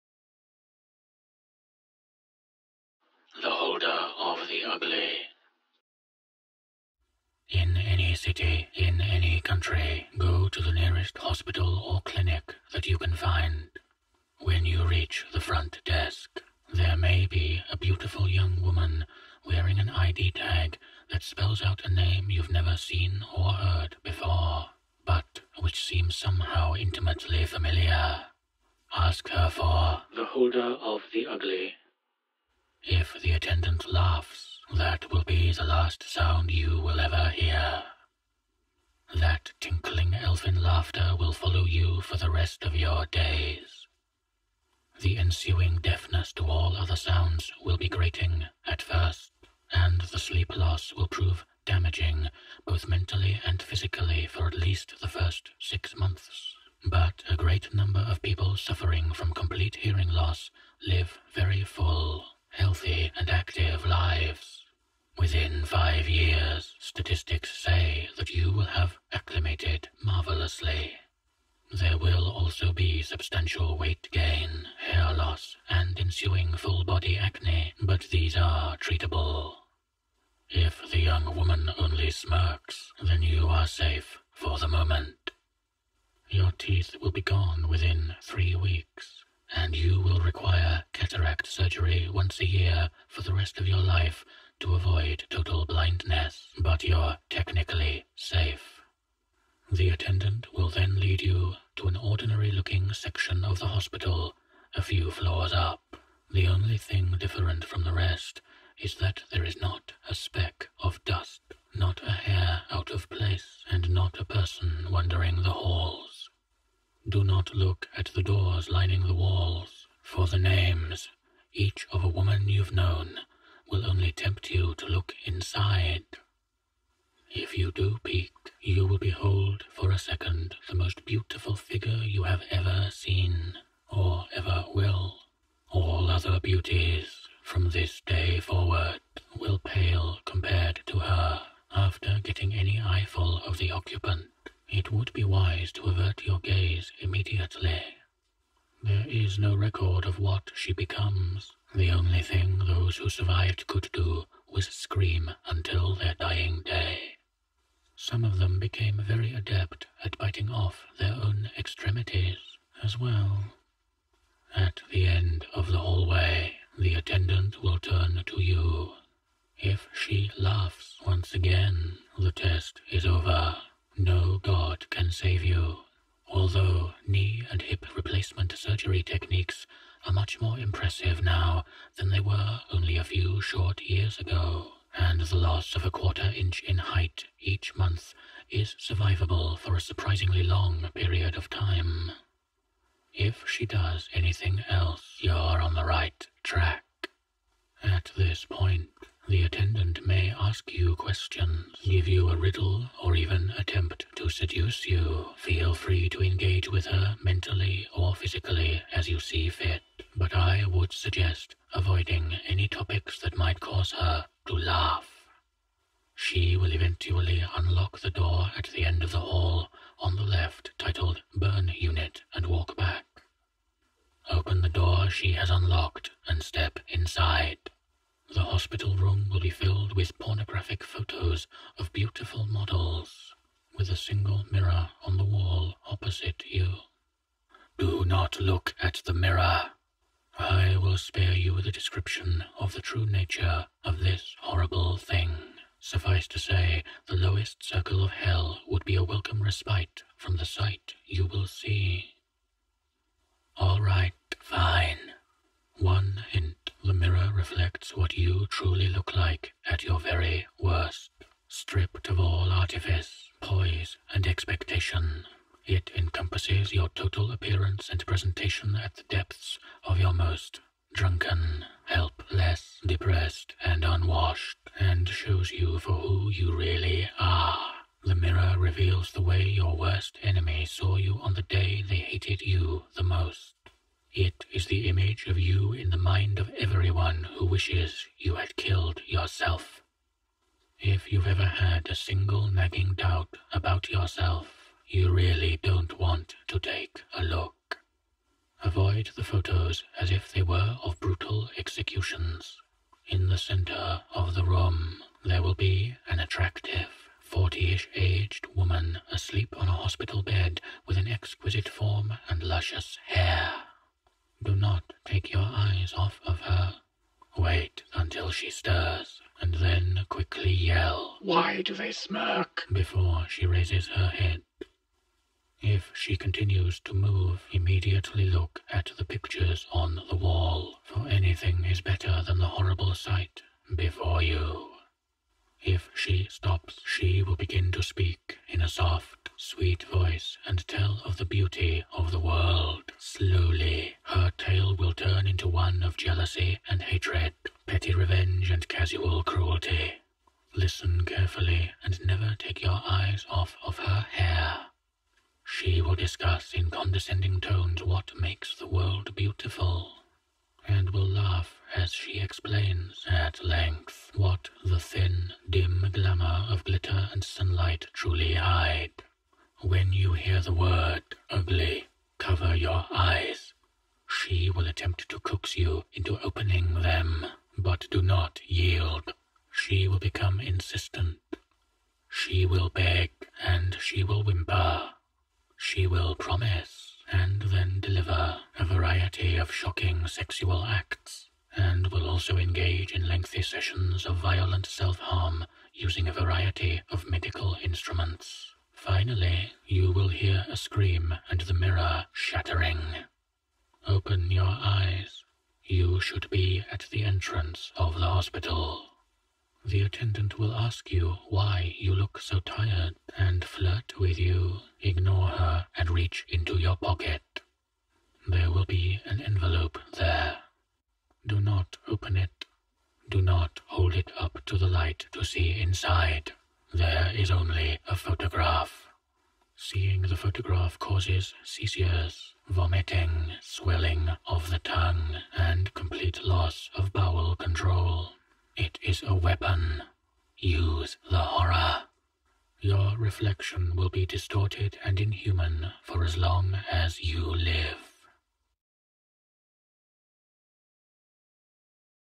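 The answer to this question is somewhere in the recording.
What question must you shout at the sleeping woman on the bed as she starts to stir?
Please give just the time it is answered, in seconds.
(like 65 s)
321 s.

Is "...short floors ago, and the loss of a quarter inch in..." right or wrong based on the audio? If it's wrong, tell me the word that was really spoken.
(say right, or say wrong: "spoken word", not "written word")
wrong: "years", not "floors".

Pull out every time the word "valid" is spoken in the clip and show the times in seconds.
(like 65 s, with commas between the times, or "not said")
not said.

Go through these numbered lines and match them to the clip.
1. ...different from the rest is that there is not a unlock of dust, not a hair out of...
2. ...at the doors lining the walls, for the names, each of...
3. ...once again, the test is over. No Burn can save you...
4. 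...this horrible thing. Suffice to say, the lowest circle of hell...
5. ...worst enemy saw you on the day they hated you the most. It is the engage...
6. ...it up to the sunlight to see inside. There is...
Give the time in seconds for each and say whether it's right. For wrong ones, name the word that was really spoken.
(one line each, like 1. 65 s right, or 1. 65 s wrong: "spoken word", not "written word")
1. 107 s wrong: "speck", not "unlock"
2. 117 s right
3. 171 s wrong: "God", not "Burn"
4. 243 s right
5. 279 s wrong: "image", not "engage"
6. 423 s wrong: "light", not "sunlight".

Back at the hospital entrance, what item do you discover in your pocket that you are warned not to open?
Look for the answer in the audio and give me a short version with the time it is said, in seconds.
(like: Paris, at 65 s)
An envelope, at 419 s.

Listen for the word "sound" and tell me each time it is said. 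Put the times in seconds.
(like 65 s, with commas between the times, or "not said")
36 s, 46 s.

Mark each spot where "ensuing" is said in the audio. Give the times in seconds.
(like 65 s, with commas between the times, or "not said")
45 s, 75 s.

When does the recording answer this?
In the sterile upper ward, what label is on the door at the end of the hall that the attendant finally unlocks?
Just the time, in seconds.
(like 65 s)
221 s.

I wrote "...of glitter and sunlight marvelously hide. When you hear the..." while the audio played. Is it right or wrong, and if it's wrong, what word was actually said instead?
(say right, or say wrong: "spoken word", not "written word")
wrong: "truly", not "marvelously".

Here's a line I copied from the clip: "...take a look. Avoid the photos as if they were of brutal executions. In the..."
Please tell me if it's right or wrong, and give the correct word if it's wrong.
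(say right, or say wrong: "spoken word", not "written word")
right.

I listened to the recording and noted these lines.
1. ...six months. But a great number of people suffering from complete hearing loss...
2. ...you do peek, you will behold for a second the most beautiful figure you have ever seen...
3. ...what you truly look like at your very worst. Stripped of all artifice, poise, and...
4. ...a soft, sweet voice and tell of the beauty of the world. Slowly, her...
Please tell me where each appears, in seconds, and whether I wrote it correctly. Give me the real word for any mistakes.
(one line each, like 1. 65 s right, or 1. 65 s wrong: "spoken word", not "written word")
1. 55 s right
2. 127 s right
3. 257 s right
4. 338 s right.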